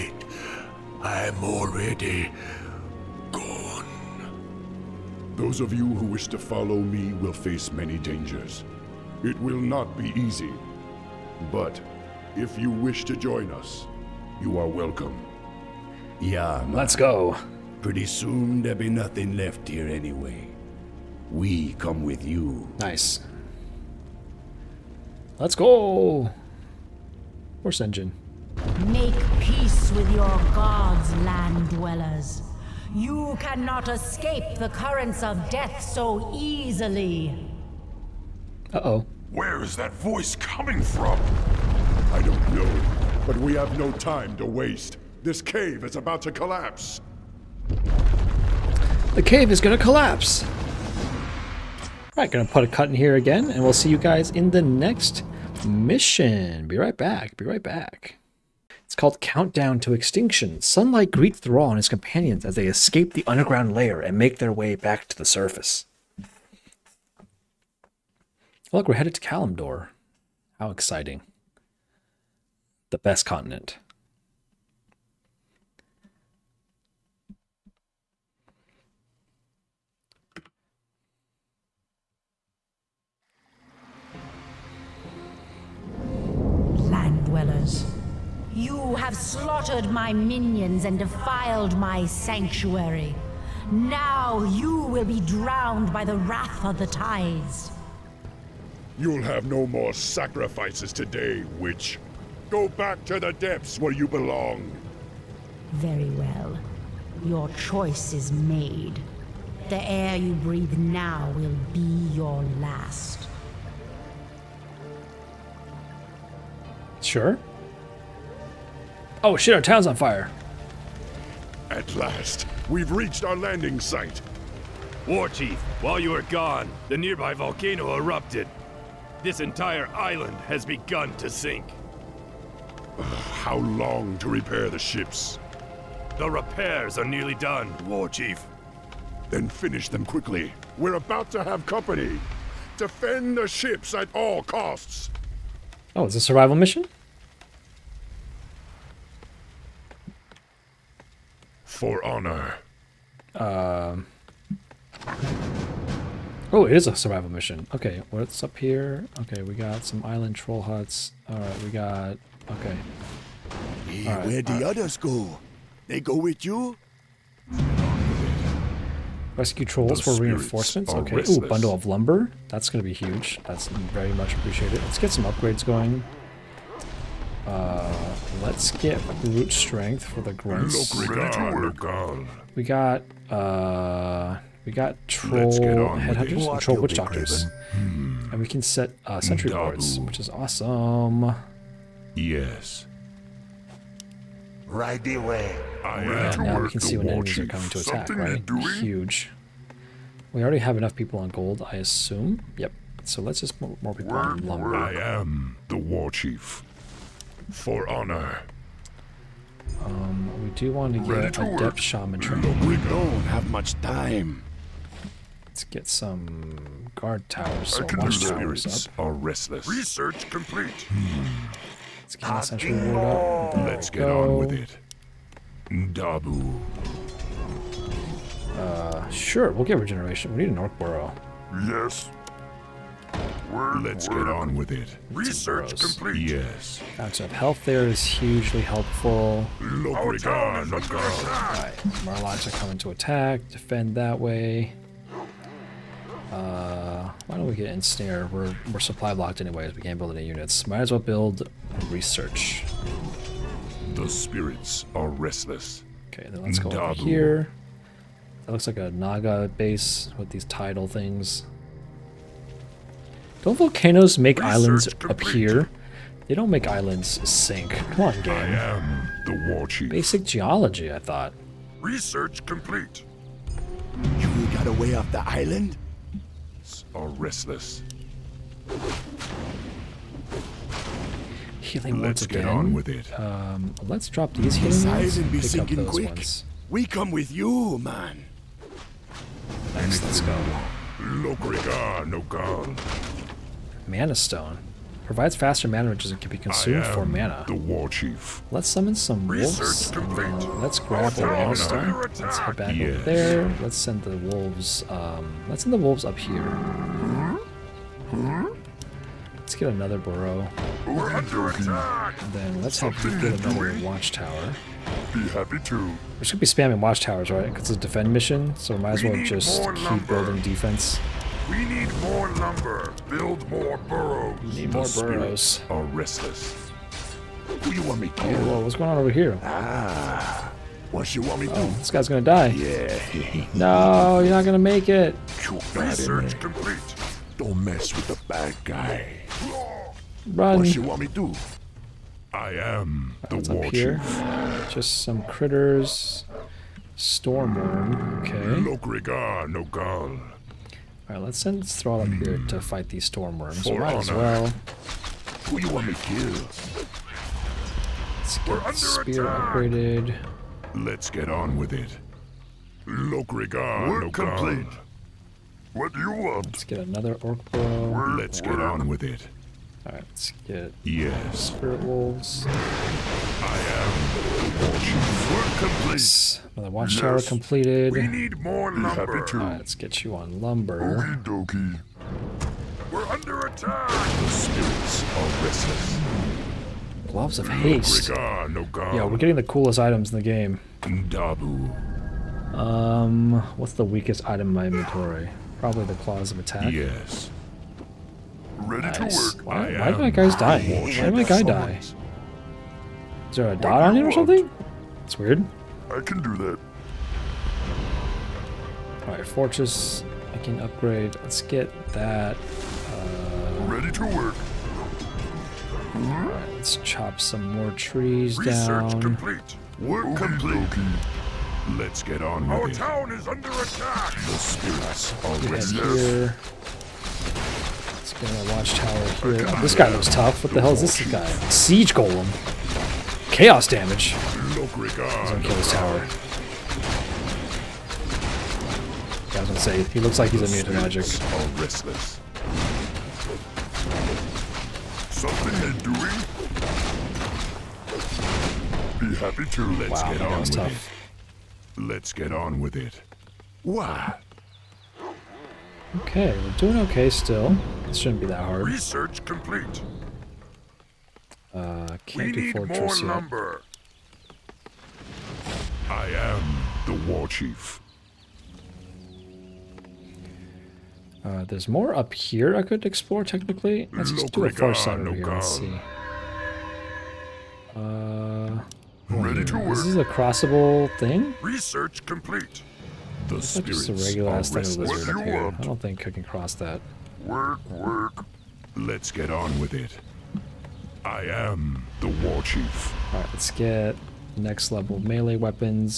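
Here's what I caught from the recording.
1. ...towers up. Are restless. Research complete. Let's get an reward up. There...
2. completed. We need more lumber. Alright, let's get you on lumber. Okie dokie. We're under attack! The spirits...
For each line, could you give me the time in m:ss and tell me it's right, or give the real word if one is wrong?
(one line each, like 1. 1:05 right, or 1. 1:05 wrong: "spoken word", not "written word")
1. 3:38 right
2. 6:17 right.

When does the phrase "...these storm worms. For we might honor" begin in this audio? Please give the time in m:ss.
5:52.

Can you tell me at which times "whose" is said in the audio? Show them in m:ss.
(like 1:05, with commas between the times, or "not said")
not said.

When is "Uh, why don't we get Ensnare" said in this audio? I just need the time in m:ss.
4:06.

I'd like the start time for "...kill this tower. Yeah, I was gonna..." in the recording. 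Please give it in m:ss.
7:15.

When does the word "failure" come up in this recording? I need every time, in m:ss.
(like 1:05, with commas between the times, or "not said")
not said.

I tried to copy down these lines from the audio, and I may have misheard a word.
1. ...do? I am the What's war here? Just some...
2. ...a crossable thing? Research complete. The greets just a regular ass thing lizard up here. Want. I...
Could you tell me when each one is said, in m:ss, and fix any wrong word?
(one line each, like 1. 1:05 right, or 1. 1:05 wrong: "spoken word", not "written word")
1. 5:41 right
2. 7:59 wrong: "spirits", not "greets".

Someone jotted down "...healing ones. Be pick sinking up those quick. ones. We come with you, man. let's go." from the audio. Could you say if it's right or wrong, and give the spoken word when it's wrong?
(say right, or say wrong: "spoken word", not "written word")
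right.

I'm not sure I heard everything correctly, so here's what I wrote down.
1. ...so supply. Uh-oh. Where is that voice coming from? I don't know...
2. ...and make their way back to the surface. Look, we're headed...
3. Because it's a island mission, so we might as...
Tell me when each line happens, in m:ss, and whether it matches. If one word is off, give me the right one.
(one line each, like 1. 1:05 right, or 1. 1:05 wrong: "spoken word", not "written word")
1. 0:35 wrong: "easily", not "supply"
2. 1:04 right
3. 5:17 wrong: "defend", not "island".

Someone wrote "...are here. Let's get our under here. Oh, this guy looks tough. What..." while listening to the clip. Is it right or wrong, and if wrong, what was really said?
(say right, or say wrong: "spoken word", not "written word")
wrong: "watchtower", not "under".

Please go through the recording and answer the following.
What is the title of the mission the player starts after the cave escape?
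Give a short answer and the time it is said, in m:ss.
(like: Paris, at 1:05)
Countdown to Extinction, at 0:59.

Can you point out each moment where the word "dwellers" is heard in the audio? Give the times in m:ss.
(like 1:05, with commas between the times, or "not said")
0:31, 1:27.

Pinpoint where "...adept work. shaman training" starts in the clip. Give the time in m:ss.
3:31.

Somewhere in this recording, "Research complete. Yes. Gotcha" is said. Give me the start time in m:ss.
3:55.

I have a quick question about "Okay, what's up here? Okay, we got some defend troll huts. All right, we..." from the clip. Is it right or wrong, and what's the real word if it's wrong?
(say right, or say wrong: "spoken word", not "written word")
wrong: "island", not "defend".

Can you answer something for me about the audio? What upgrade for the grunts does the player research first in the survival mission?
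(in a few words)
Brute strength.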